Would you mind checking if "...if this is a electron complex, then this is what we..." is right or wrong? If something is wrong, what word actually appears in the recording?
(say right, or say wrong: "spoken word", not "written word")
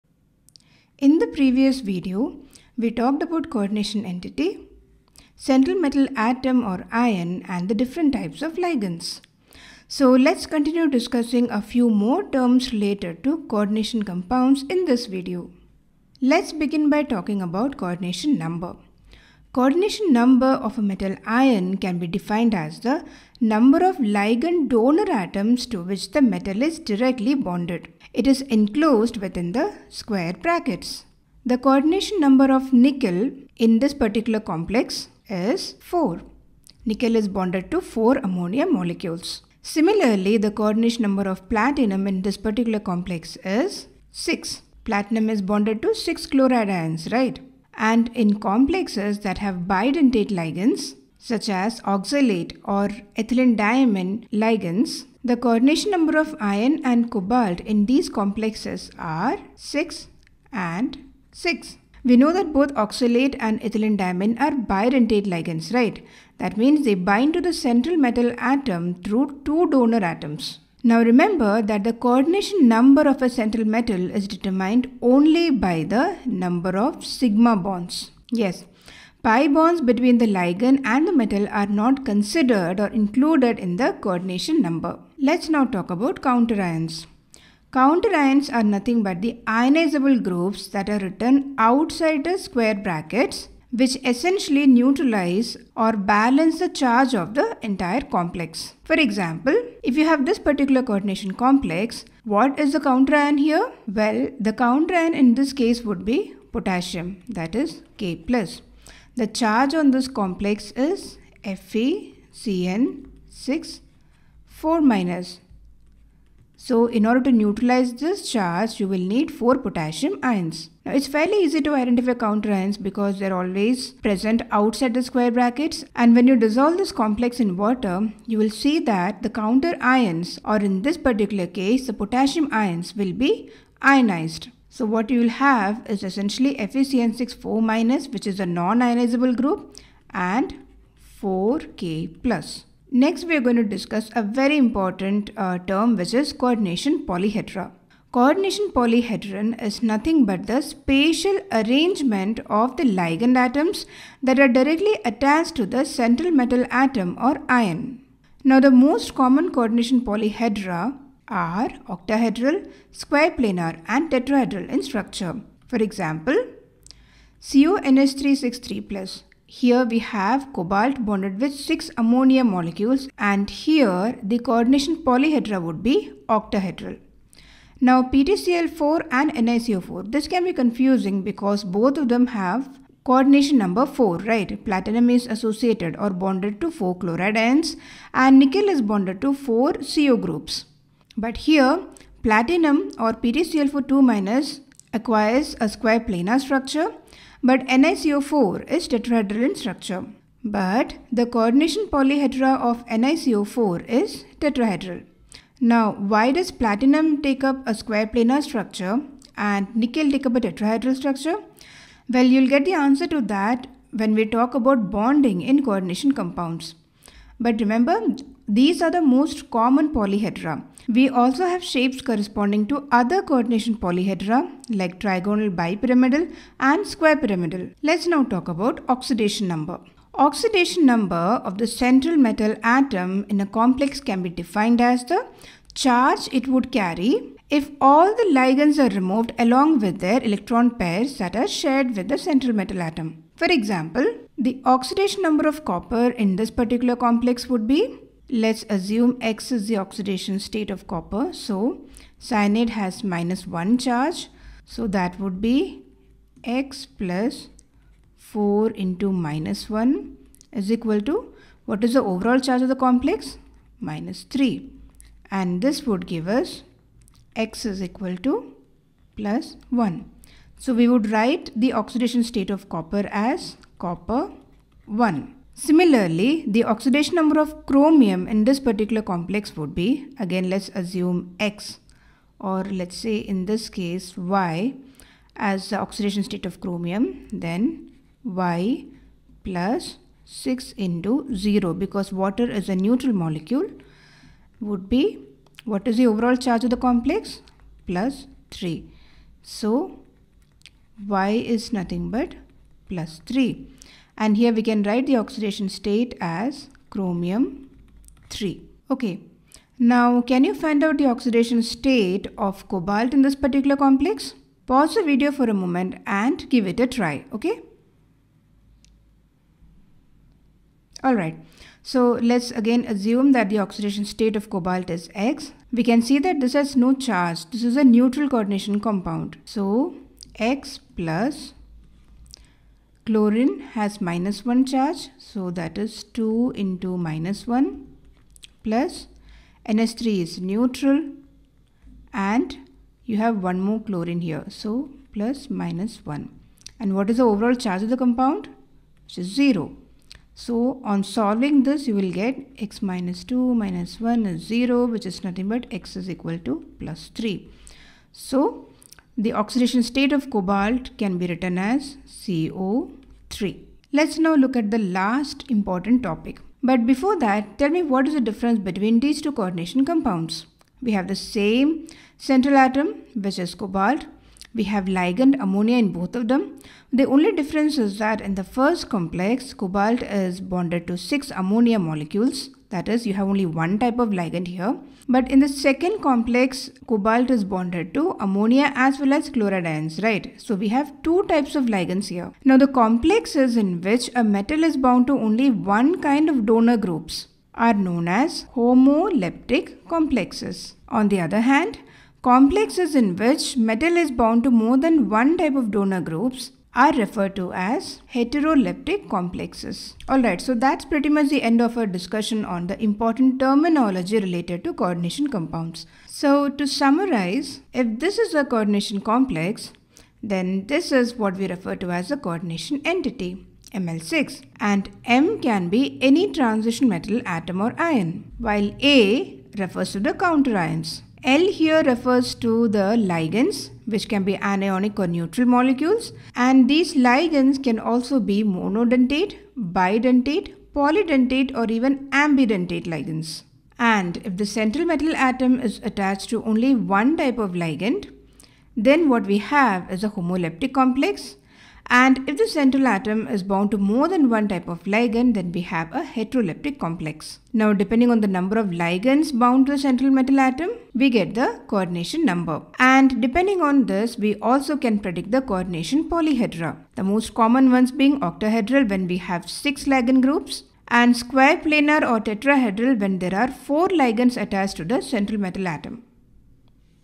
wrong: "coordination", not "electron".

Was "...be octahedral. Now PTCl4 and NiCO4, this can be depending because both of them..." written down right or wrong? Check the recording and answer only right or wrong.
wrong.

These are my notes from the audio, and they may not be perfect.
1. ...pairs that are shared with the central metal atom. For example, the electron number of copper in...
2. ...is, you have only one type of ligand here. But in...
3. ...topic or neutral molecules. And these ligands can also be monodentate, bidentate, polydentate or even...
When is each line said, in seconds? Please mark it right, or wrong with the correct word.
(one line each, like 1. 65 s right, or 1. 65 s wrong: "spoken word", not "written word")
1. 240 s wrong: "oxidation", not "electron"
2. 382 s right
3. 434 s wrong: "anionic", not "topic".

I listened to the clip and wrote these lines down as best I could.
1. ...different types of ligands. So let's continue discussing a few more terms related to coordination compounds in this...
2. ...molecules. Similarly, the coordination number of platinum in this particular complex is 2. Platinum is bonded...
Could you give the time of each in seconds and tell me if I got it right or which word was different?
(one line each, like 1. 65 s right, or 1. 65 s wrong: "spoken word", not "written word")
1. 7 s right
2. 38 s wrong: "6", not "2".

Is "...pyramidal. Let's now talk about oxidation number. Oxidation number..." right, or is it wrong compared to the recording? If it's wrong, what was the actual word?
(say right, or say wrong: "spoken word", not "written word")
right.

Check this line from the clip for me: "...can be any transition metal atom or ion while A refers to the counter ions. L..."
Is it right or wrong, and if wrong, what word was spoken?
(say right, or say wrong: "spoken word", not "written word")
right.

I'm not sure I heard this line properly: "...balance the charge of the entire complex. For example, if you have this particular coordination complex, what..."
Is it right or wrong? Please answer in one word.
right.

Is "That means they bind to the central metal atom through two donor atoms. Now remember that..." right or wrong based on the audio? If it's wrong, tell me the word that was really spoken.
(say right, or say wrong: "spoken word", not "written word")
right.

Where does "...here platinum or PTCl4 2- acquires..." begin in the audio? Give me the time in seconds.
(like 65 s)
191 s.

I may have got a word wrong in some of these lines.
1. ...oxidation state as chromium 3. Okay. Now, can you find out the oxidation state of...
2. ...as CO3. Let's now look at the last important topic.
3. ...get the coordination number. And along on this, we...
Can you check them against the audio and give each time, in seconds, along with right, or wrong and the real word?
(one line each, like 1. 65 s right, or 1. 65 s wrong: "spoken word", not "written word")
1. 305 s right
2. 361 s right
3. 461 s wrong: "depending", not "along".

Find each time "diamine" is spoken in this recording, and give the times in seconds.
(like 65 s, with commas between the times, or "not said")
53 s, 63 s.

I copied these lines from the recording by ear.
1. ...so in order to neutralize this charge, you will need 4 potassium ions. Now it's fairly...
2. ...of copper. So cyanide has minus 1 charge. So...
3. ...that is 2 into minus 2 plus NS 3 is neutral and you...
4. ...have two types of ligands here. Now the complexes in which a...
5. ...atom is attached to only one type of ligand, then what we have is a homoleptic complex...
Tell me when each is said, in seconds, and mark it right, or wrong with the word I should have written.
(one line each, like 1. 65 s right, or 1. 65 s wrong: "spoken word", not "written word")
1. 116 s right
2. 250 s right
3. 335 s wrong: "1", not "2"
4. 390 s right
5. 445 s right.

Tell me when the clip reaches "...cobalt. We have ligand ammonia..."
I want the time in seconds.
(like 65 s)
373 s.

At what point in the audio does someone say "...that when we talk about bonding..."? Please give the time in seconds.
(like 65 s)
213 s.